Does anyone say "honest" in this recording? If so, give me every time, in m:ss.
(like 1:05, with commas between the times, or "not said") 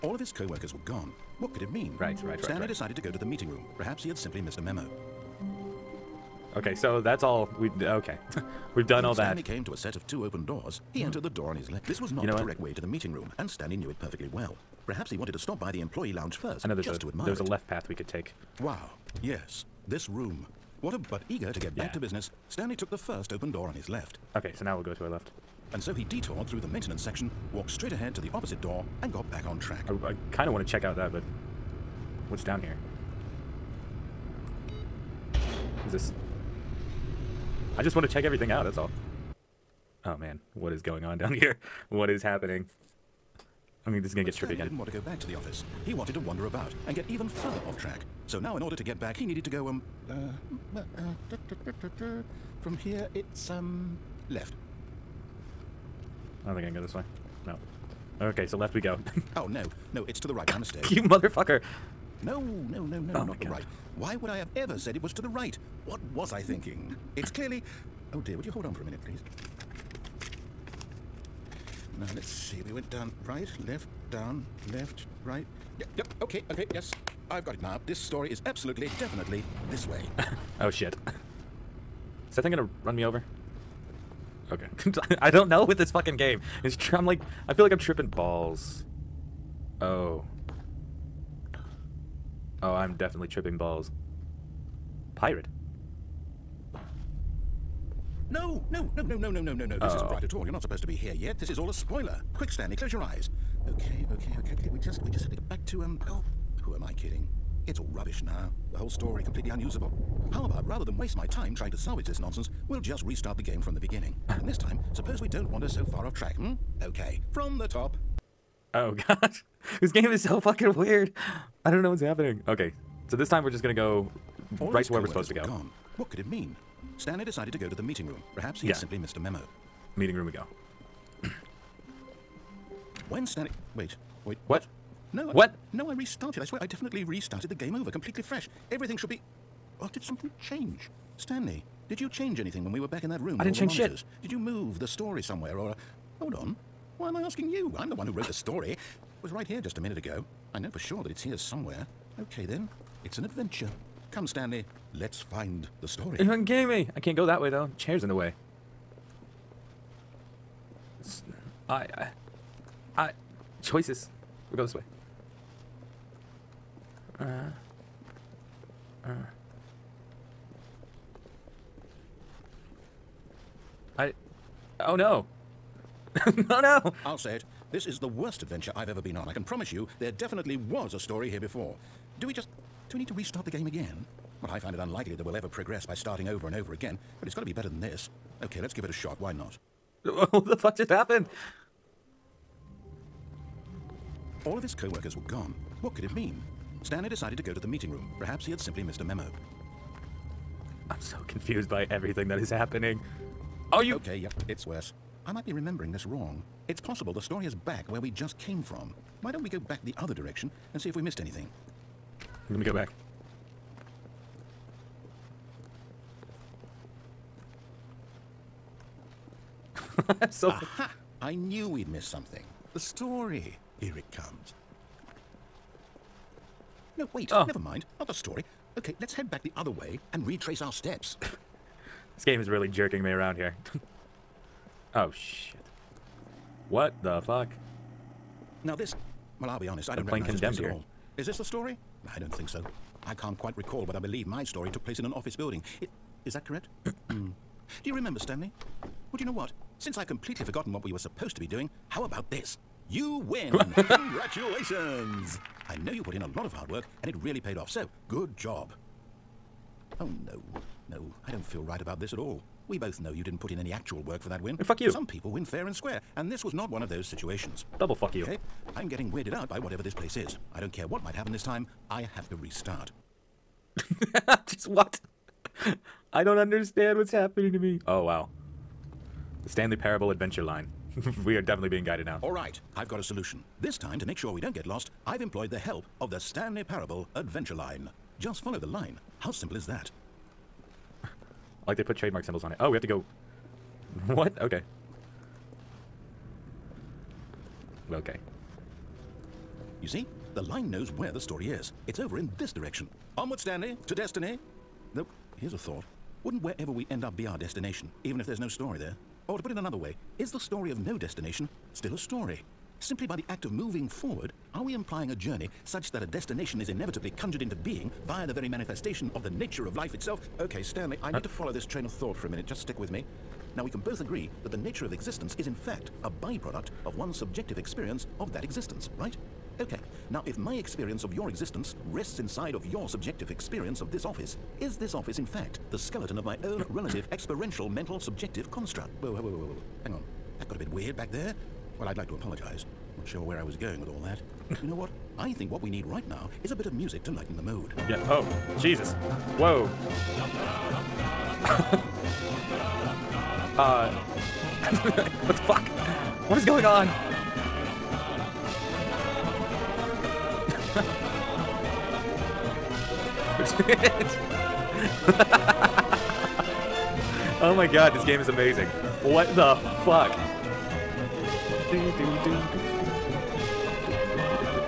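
3:59.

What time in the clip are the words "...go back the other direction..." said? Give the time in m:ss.
3:29.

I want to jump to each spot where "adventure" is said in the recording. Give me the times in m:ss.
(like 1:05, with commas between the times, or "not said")
2:33, 2:58, 4:40, 4:47.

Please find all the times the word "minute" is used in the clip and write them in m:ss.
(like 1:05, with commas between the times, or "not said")
1:08, 2:29, 5:22.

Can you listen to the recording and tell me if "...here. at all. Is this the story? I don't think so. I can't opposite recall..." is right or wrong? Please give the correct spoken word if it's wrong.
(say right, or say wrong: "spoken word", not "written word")
wrong: "quite", not "opposite".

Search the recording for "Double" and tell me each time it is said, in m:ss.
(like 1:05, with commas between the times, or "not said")
4:27.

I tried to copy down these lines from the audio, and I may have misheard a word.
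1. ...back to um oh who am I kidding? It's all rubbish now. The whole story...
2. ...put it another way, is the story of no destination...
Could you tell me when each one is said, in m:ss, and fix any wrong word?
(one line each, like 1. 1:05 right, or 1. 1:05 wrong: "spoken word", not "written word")
1. 1:45 right
2. 5:09 right.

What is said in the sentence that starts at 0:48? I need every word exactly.
So now, in order to get back, he needed to go, um...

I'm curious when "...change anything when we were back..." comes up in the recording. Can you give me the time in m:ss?
2:22.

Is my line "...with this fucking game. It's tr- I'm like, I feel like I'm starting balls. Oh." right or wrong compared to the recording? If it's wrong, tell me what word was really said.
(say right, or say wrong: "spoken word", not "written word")
wrong: "tripping", not "starting".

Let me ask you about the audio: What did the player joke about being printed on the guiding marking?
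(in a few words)
trademark symbols.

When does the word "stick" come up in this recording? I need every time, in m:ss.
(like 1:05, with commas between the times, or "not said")
5:22.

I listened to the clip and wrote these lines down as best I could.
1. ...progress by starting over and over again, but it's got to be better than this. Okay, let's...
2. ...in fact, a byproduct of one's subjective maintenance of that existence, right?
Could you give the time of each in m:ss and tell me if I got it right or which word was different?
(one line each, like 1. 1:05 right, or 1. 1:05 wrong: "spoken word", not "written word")
1. 3:05 right
2. 5:25 wrong: "experience", not "maintenance".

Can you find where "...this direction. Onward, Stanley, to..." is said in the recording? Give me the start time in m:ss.
5:02.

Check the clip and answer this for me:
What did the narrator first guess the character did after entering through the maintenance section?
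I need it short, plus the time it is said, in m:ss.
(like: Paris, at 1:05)
walked straight ahead, at 0:27.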